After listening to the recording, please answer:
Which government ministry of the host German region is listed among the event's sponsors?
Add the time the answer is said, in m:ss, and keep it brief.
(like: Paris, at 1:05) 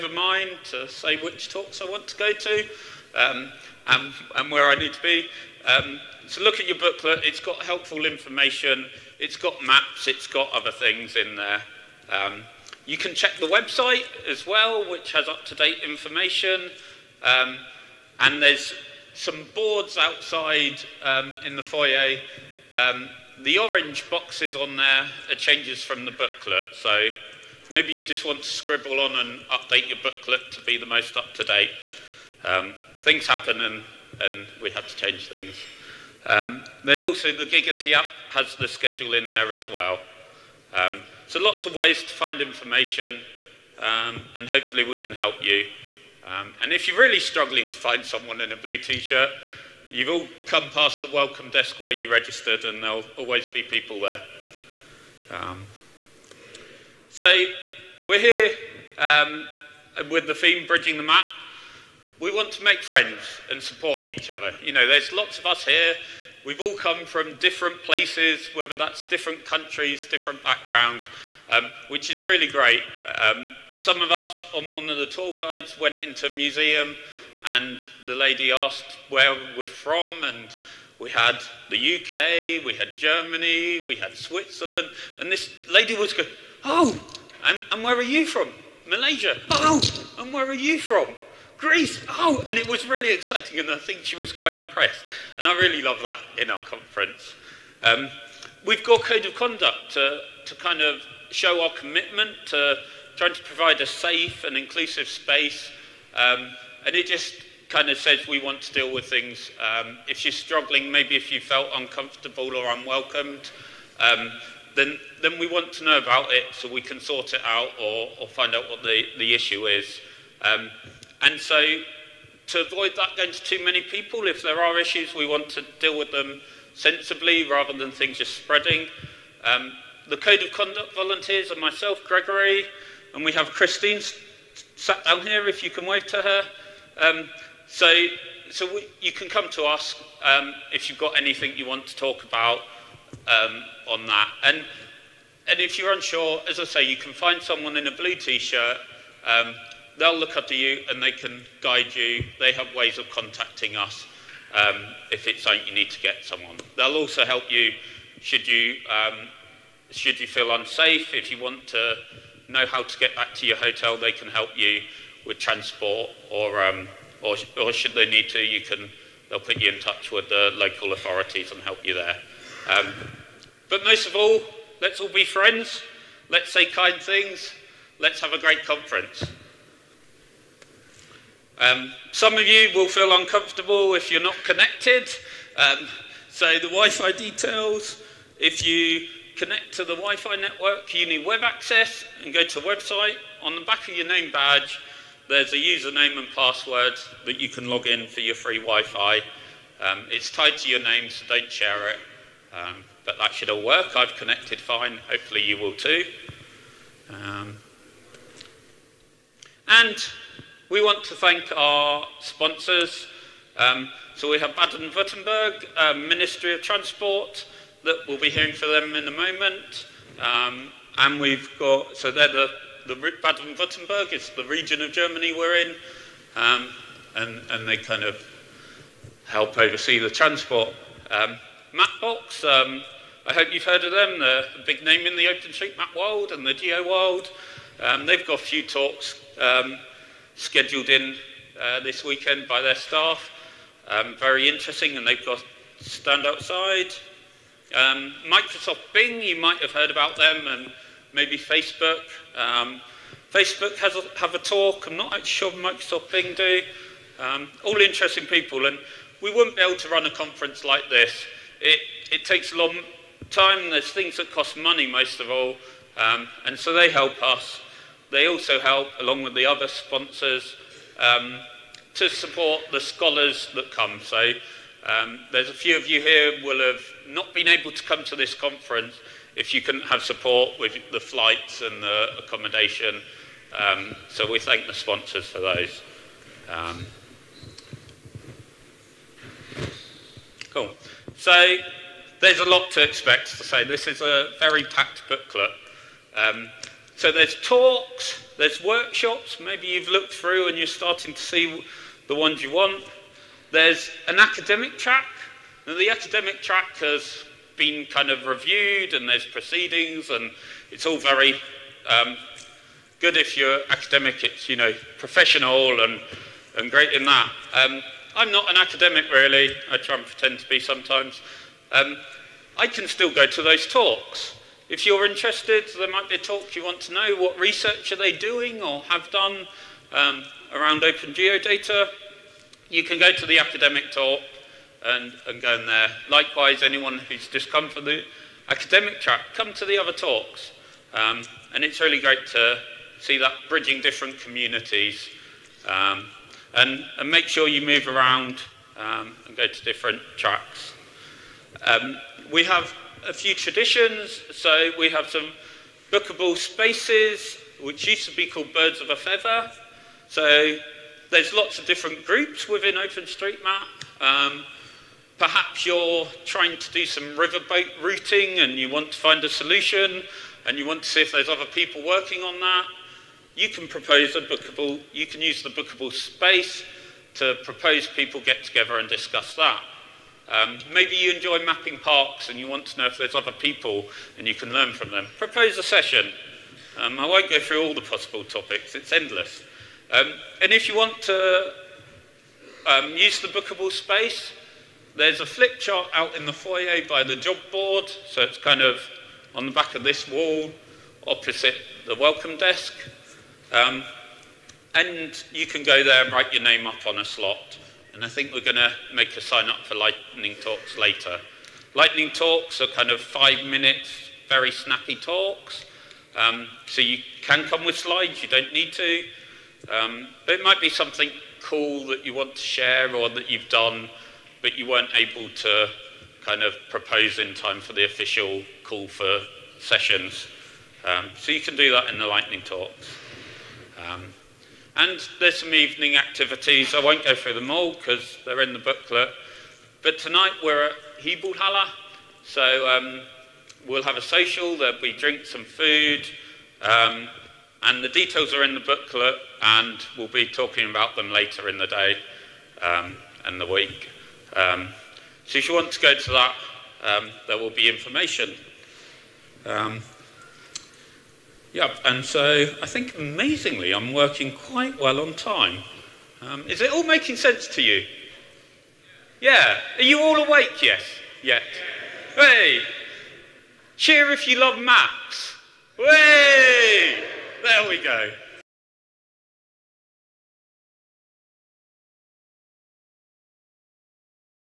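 Ministry of Transport, at 3:36.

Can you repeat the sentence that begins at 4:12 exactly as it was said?
Um, Facebook has a, have a talk.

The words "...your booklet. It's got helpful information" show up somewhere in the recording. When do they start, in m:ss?
0:06.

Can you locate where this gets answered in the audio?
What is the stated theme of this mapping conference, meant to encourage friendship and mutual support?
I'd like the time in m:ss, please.
1:00.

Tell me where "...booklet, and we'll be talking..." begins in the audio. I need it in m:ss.
7:28.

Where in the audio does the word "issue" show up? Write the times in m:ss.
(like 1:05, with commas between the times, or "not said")
1:59, 2:04.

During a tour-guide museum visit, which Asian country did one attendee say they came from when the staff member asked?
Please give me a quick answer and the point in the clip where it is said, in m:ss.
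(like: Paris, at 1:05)
Malaysia, at 1:28.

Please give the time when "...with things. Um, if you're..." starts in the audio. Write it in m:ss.
1:48.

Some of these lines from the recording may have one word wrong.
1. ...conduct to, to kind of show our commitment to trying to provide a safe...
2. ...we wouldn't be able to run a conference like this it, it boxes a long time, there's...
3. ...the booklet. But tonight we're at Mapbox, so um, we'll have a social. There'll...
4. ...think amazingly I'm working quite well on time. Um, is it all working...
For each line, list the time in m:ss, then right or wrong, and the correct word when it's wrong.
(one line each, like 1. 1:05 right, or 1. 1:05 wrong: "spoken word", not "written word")
1. 1:39 right
2. 4:19 wrong: "takes", not "boxes"
3. 7:18 wrong: "Hibulhala", not "Mapbox"
4. 7:42 wrong: "making", not "working".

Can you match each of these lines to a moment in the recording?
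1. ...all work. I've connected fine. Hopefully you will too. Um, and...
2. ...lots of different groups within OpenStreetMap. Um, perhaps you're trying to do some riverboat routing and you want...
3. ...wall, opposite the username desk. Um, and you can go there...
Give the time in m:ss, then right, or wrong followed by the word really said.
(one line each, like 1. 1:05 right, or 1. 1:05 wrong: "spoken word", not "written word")
1. 3:23 right
2. 6:01 right
3. 6:40 wrong: "welcome", not "username".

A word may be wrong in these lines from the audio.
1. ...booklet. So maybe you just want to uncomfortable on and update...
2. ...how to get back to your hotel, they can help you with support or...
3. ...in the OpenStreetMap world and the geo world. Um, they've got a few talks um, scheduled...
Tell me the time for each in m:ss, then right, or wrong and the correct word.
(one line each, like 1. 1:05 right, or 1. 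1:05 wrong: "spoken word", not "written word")
1. 0:26 wrong: "scribble", not "uncomfortable"
2. 2:42 wrong: "transport", not "support"
3. 3:55 right.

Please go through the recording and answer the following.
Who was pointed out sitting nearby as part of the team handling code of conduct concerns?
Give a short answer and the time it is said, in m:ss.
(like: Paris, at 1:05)
Christine, at 2:13.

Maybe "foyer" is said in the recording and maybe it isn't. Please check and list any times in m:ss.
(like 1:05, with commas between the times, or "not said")
0:21, 6:36.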